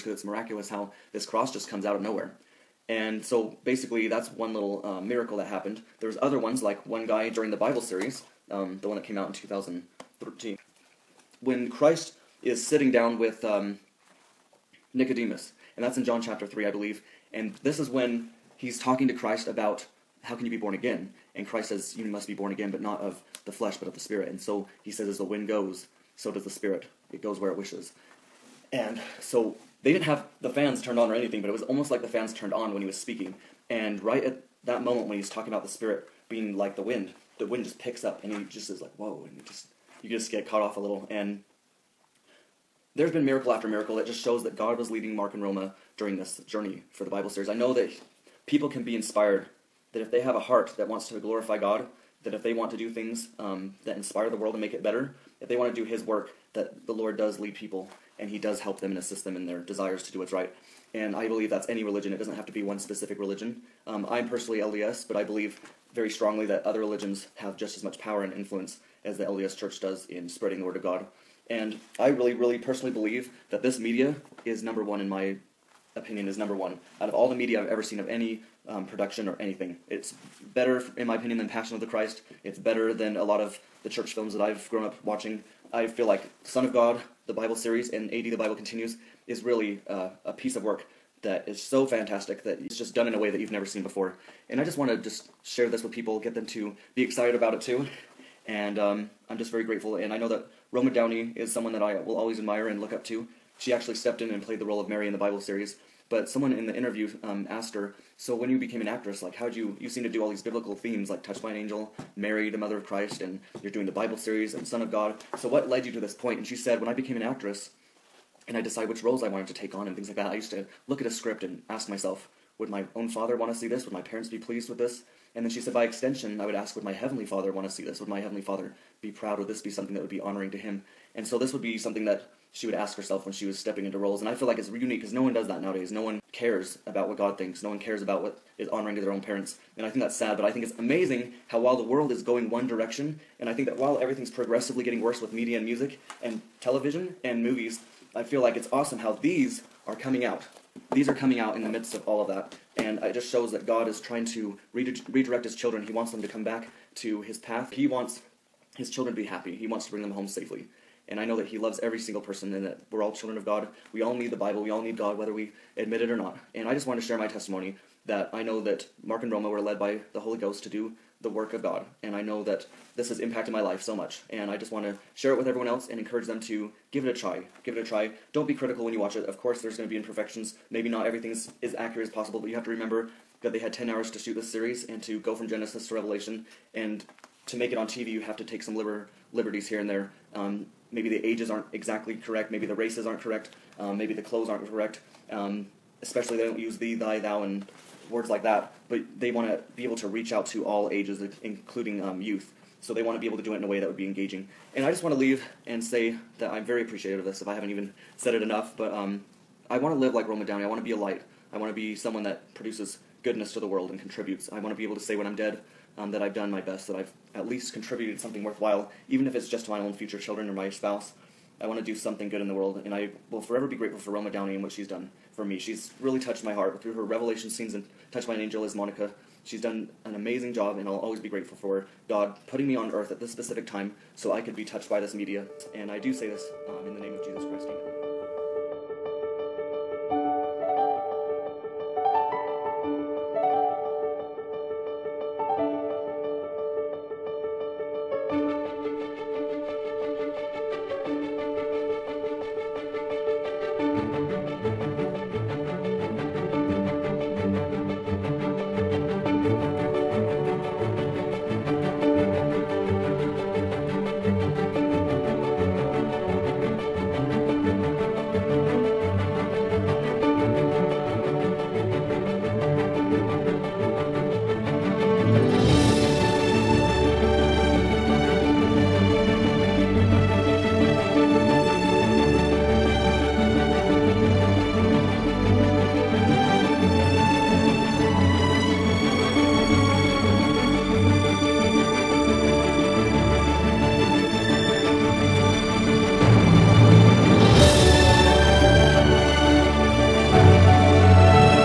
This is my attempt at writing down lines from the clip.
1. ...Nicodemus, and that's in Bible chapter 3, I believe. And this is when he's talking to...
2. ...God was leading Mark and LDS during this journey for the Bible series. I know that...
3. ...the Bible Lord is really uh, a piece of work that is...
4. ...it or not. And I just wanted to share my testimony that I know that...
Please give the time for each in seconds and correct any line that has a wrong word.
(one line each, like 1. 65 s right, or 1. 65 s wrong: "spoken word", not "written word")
1. 14 s wrong: "John", not "Bible"
2. 44 s wrong: "Roma", not "LDS"
3. 88 s wrong: "Continues", not "Lord"
4. 165 s right.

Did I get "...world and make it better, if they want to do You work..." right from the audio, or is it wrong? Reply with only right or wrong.
wrong.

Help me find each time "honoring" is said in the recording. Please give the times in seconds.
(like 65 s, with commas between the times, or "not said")
130 s, 138 s.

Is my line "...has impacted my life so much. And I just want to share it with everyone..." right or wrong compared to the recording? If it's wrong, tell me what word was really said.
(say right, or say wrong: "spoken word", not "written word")
right.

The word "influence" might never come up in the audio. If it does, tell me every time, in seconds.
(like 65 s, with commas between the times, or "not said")
68 s.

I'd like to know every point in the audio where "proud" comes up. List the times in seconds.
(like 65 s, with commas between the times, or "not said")
129 s.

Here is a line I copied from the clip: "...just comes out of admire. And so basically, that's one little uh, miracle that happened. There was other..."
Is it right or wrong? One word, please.
wrong.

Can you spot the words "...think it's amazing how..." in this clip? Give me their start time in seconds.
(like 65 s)
140 s.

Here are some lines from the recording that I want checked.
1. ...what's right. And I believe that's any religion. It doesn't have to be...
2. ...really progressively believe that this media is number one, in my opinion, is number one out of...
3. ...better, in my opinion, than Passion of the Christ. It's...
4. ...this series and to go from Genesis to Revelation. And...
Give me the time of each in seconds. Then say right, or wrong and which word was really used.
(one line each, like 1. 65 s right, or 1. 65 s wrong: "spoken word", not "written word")
1. 60 s right
2. 72 s wrong: "personally", not "progressively"
3. 80 s right
4. 184 s right.